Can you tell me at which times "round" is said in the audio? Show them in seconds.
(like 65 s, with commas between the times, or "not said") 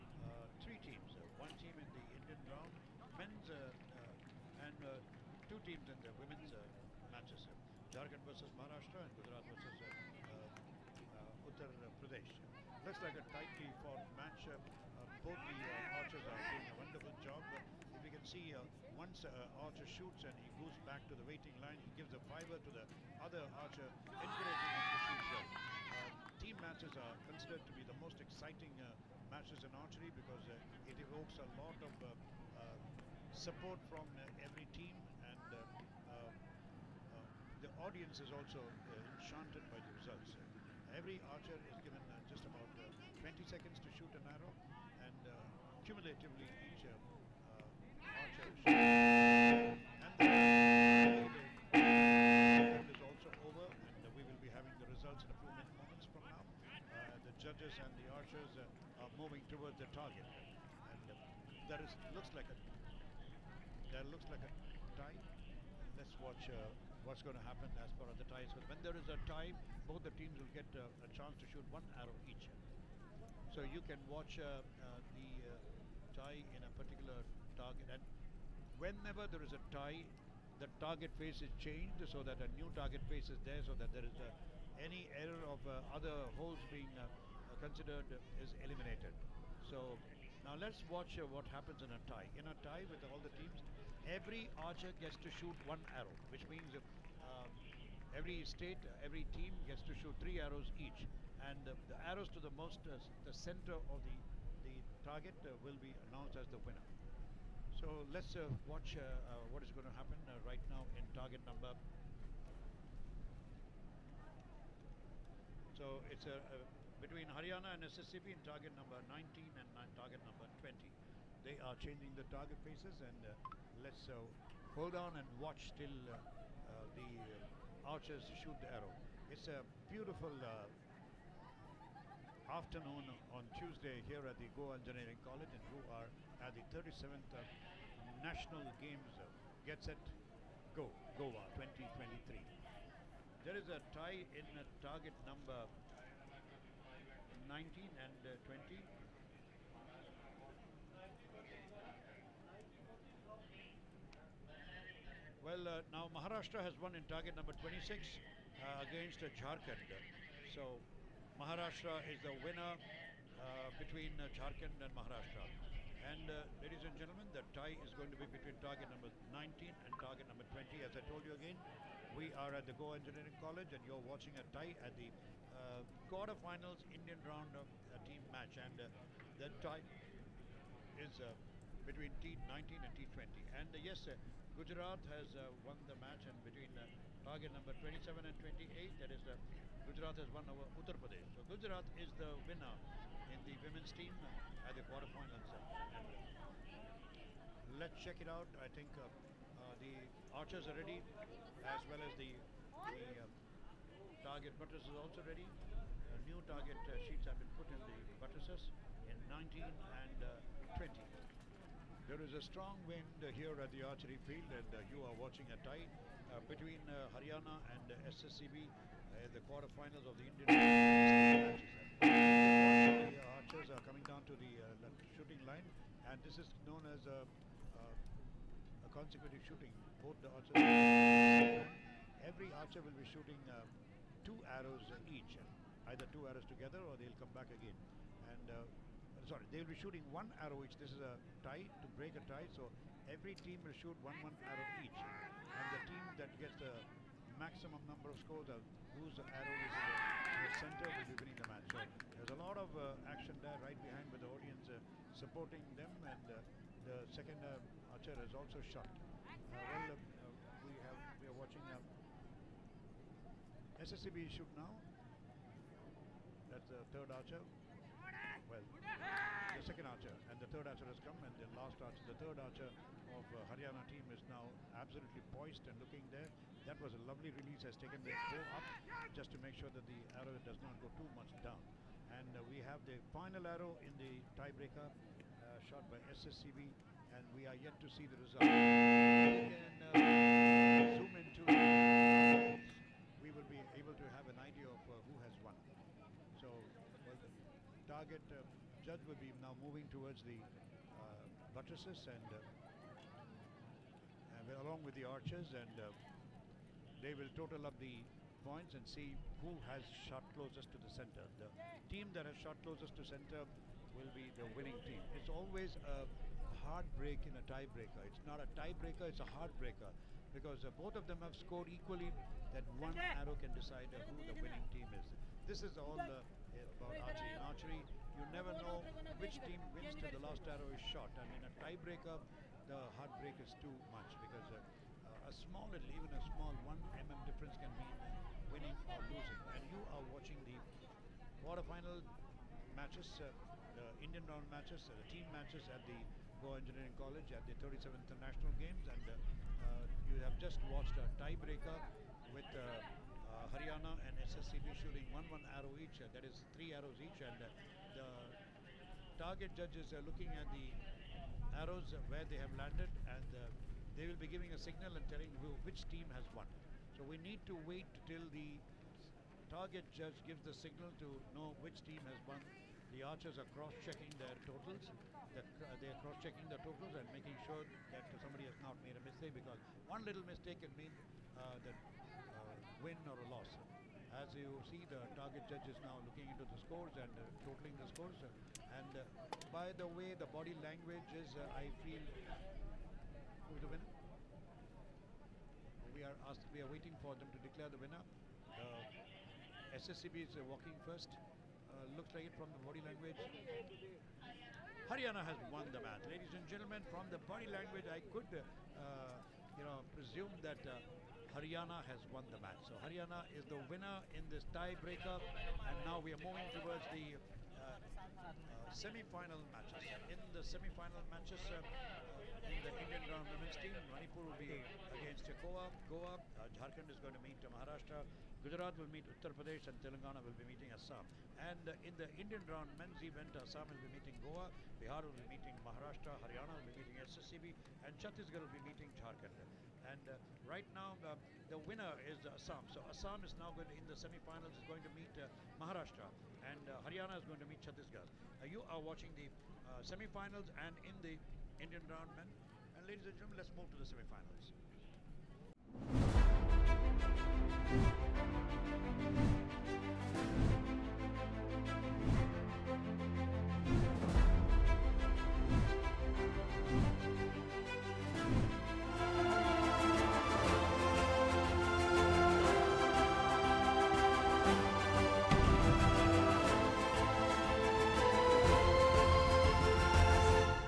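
2 s, 177 s, 344 s, 423 s, 432 s, 451 s.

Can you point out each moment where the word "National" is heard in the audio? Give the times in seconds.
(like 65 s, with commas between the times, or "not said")
138 s, 348 s.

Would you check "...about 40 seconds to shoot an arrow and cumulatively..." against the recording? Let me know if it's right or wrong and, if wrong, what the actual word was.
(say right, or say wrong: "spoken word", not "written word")
wrong: "20", not "40".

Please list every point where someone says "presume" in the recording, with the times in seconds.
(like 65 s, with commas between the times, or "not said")
409 s.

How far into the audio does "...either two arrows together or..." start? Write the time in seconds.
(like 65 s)
235 s.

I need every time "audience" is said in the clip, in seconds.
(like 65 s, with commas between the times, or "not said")
37 s, 254 s.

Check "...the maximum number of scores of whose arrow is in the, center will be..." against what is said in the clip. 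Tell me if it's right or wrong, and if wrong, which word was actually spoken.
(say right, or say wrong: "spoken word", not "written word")
right.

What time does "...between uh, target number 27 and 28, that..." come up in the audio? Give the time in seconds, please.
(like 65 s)
186 s.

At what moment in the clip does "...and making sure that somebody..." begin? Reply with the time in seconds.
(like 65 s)
377 s.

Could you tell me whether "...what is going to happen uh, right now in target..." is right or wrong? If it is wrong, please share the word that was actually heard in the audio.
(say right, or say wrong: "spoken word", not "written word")
right.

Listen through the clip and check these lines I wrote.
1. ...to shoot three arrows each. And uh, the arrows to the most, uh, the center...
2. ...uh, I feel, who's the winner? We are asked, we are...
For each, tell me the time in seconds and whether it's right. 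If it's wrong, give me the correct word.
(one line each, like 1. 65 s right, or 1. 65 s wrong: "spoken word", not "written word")
1. 99 s right
2. 391 s right.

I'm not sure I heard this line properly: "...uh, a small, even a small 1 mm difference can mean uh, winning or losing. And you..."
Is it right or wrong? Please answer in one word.
right.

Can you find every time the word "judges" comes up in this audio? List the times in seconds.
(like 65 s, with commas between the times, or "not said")
57 s, 298 s, 359 s, 369 s, 385 s.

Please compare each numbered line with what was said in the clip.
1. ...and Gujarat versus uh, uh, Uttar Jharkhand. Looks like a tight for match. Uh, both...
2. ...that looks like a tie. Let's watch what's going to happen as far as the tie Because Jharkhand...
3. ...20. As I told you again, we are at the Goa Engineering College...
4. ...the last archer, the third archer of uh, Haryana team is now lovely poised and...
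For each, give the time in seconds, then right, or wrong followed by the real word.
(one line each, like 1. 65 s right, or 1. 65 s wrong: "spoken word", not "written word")
1. 9 s wrong: "Pradesh", not "Jharkhand"
2. 63 s wrong: "When", not "Jharkhand"
3. 170 s right
4. 271 s wrong: "absolutely", not "lovely".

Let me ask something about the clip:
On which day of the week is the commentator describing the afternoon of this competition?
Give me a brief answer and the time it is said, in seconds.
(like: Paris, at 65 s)
Tuesday, at 133 s.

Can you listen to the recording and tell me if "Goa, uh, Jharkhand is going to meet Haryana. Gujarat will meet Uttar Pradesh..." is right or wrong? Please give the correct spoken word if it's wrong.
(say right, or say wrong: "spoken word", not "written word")
wrong: "Maharashtra", not "Haryana".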